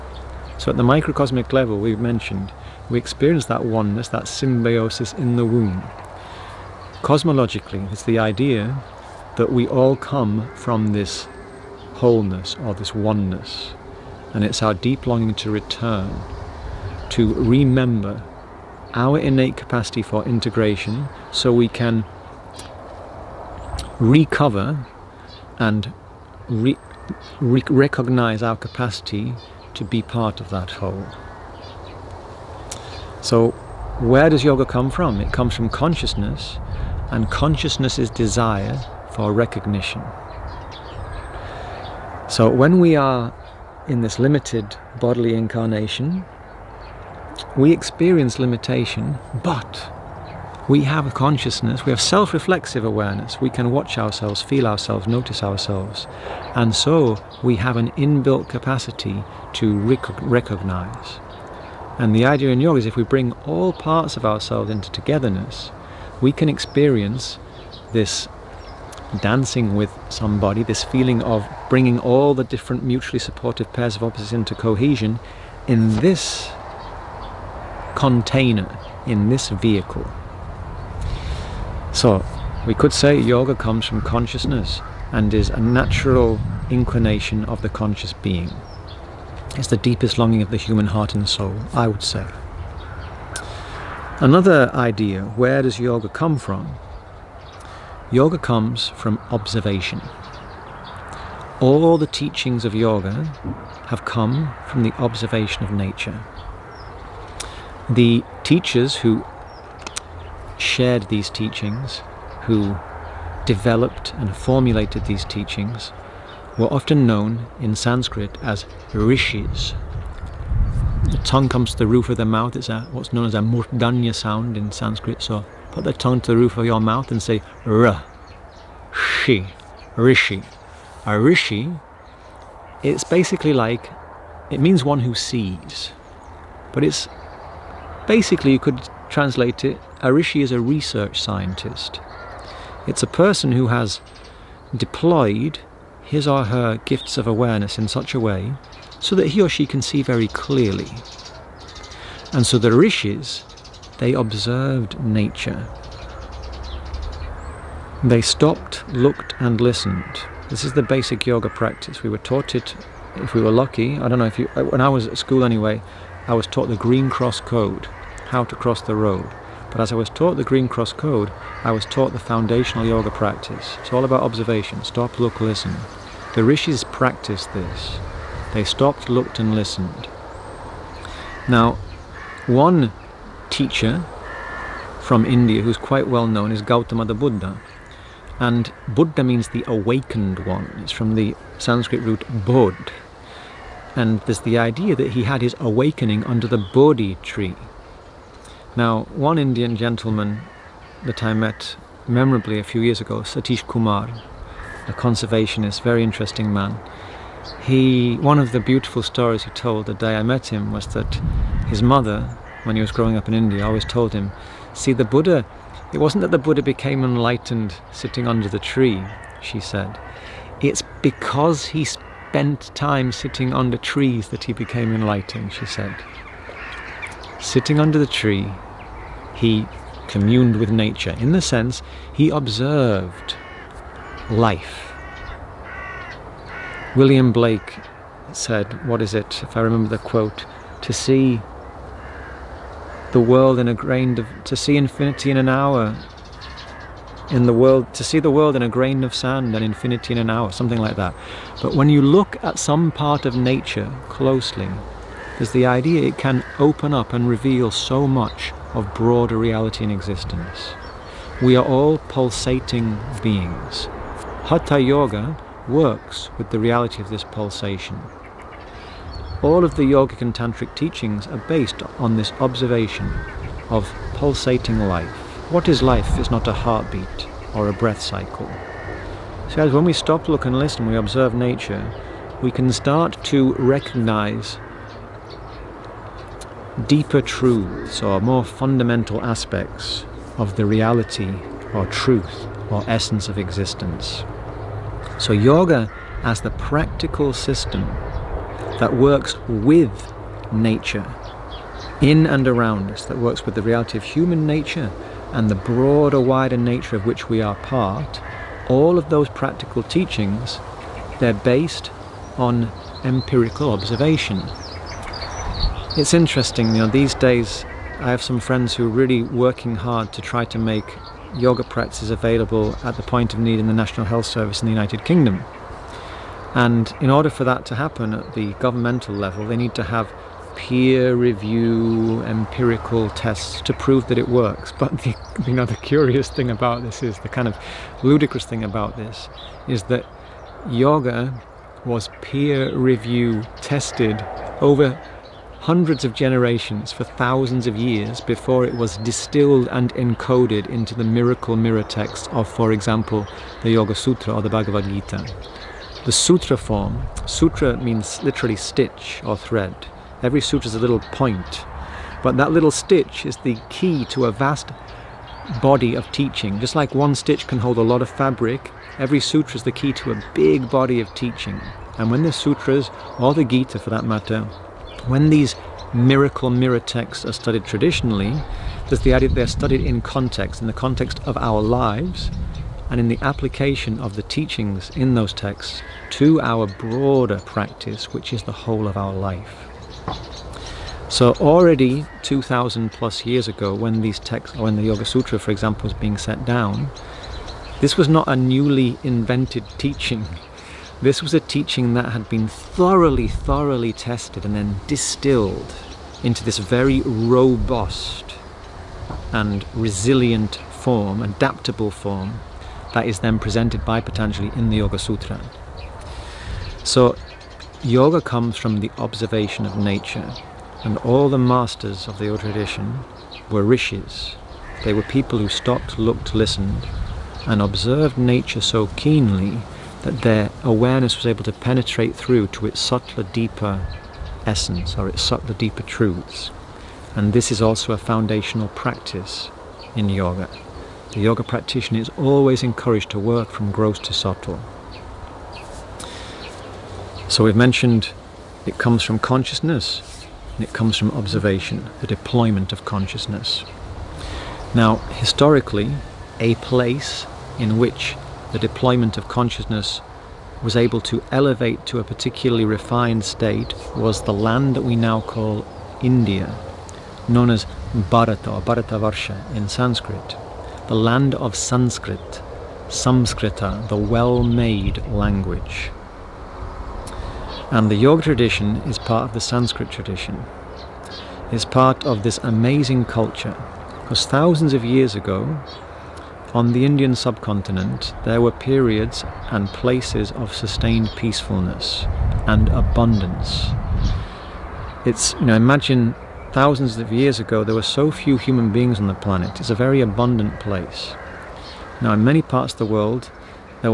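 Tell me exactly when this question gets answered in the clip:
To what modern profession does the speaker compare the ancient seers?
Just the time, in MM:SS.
02:20.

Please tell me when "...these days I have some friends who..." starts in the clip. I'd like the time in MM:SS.
05:16.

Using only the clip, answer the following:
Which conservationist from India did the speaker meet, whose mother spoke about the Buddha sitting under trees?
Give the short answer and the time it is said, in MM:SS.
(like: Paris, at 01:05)
Satish Kumar, at 03:23.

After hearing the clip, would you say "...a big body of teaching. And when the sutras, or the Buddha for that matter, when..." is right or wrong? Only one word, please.
wrong.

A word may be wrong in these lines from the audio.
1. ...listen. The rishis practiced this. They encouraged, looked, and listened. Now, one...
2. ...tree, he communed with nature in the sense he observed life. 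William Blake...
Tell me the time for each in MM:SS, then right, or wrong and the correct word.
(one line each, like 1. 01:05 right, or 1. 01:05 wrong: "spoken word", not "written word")
1. 02:55 wrong: "stopped", not "encouraged"
2. 03:48 right.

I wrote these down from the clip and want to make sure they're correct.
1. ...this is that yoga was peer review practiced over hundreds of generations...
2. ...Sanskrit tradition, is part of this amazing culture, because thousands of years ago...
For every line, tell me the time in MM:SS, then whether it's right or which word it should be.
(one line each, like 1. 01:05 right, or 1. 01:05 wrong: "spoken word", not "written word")
1. 05:38 wrong: "tested", not "practiced"
2. 07:59 right.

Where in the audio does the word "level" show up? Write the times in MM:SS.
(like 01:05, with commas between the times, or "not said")
00:01, 05:29.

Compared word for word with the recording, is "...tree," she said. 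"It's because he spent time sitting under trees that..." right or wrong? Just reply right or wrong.
right.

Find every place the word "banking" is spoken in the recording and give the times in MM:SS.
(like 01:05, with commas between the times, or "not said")
not said.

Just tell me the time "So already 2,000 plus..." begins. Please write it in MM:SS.
06:31.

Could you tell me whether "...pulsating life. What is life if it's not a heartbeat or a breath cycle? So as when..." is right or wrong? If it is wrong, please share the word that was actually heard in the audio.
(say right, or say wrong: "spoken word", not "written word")
right.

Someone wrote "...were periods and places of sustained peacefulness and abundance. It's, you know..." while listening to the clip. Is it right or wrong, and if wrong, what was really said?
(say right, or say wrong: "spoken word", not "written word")
right.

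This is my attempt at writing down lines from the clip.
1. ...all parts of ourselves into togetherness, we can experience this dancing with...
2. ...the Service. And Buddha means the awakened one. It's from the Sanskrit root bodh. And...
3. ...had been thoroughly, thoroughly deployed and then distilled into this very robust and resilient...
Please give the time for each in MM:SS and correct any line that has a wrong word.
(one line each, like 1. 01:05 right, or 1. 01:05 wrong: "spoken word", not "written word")
1. 01:03 right
2. 03:07 wrong: "Buddha", not "Service"
3. 06:42 wrong: "tested", not "deployed".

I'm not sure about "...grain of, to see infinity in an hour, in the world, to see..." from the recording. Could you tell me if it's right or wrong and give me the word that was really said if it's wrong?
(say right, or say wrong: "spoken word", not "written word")
right.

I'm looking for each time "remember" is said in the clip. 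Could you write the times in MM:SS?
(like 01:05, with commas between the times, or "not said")
00:17, 03:59.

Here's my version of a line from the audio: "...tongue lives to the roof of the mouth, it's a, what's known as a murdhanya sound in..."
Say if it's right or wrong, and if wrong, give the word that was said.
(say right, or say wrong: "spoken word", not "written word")
wrong: "comes", not "lives".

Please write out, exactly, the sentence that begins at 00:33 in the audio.
So, where does yoga come from?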